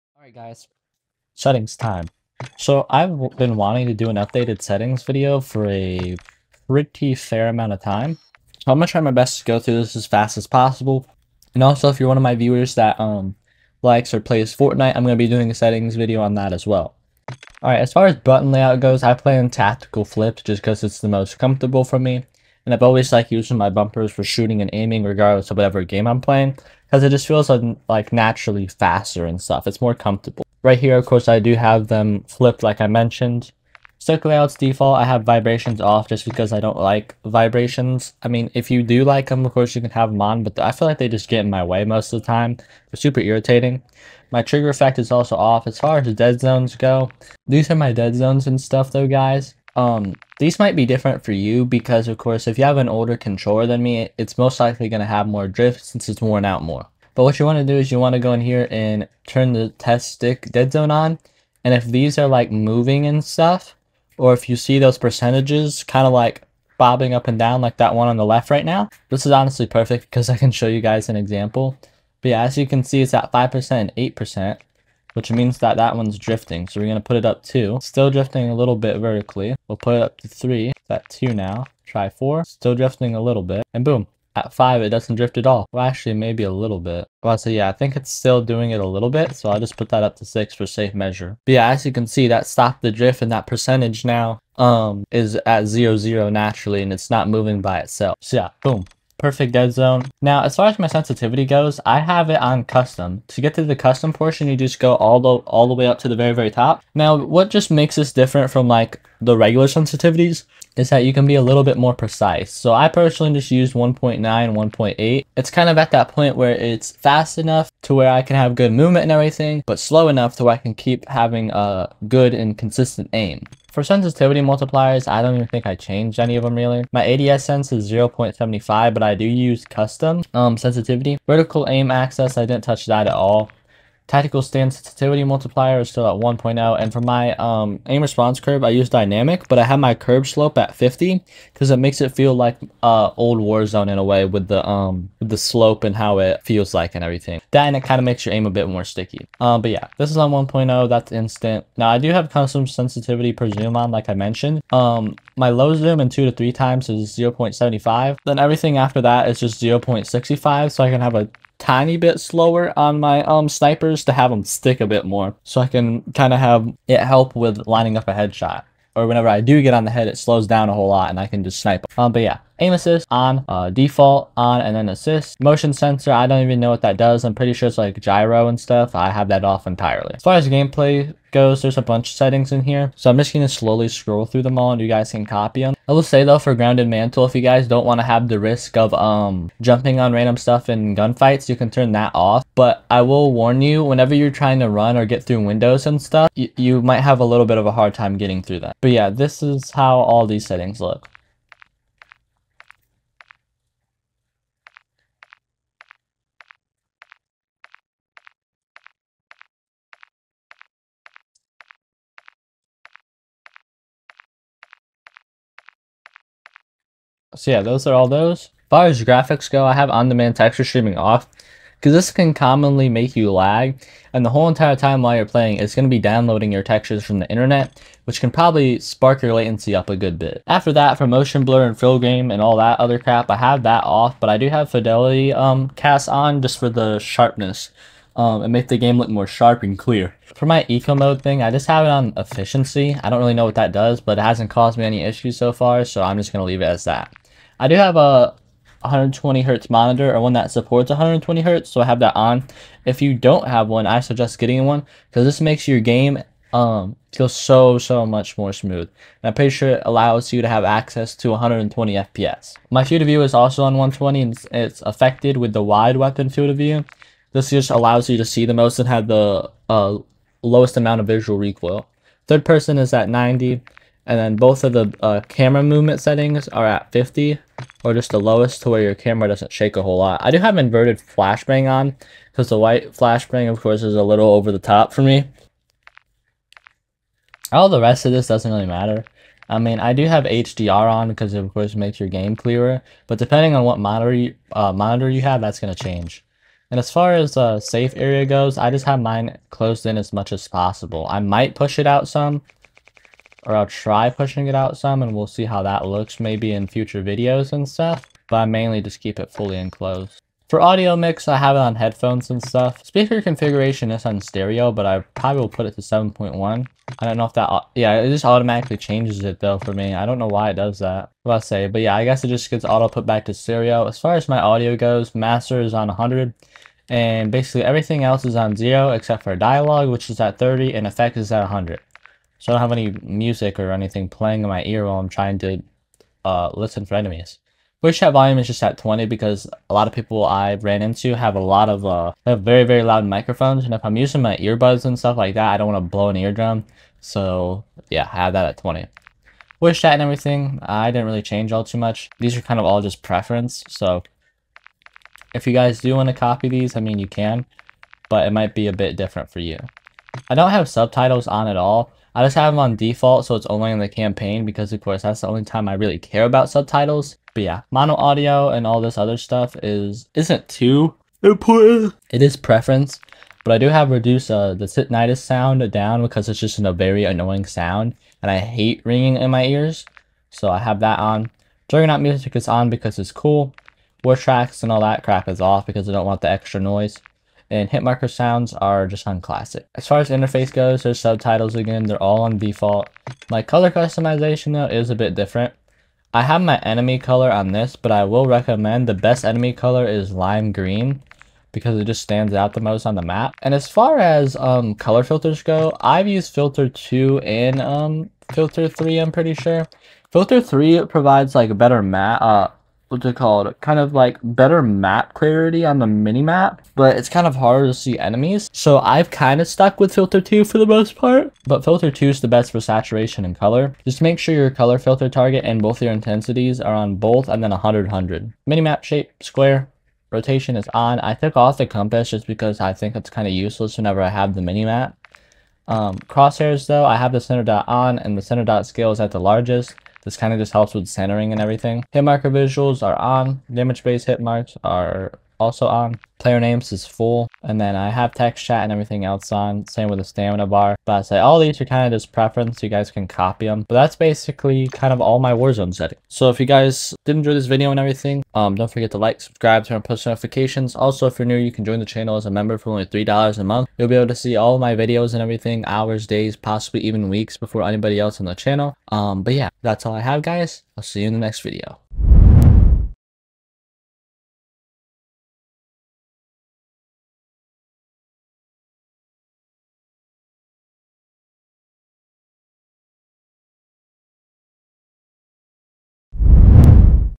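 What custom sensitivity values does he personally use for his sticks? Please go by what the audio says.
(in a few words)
1.9, 1.8.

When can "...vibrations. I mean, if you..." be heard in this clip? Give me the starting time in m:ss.
0:37.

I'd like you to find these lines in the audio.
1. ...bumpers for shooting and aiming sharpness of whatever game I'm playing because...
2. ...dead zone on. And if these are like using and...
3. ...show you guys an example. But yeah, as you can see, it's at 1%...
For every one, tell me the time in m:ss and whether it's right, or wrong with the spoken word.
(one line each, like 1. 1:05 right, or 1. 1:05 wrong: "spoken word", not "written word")
1. 0:23 wrong: "regardless", not "sharpness"
2. 1:00 wrong: "moving", not "using"
3. 1:10 wrong: "5", not "1".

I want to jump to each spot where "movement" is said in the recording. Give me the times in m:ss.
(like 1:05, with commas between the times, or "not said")
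1:58, 4:35.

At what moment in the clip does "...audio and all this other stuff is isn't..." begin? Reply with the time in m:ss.
6:07.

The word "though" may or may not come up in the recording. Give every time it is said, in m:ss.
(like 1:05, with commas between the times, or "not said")
0:48, 3:06, 5:19, 6:34, 7:16.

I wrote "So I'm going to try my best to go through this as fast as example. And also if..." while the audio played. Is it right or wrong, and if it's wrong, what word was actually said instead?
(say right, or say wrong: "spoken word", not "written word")
wrong: "possible", not "example".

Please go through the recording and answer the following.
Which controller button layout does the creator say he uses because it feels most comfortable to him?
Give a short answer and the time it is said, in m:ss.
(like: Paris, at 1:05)
Tactical flips, at 0:19.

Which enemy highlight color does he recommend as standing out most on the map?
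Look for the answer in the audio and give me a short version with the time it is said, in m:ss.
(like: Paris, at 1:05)
Lime green, at 6:40.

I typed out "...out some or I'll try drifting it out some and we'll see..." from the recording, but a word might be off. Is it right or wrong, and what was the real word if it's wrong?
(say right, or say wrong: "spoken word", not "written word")
wrong: "pushing", not "drifting".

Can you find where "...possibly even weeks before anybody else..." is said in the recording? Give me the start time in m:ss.
7:46.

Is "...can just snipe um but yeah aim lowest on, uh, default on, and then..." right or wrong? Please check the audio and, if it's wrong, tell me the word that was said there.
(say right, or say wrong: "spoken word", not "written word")
wrong: "assist", not "lowest".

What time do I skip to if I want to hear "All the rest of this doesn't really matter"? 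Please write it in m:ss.
4:47.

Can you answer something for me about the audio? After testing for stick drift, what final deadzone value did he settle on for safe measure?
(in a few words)
6.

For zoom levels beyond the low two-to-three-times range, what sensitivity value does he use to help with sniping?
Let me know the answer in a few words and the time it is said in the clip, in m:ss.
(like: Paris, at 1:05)
0.65, at 2:39.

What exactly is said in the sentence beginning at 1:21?
Try four, still drifting a little bit, and boom.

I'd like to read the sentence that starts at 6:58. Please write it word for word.
So I've kind of stuck with filter two for the most part, but filter two is the best for saturation and color.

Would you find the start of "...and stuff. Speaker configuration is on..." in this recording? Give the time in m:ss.
5:12.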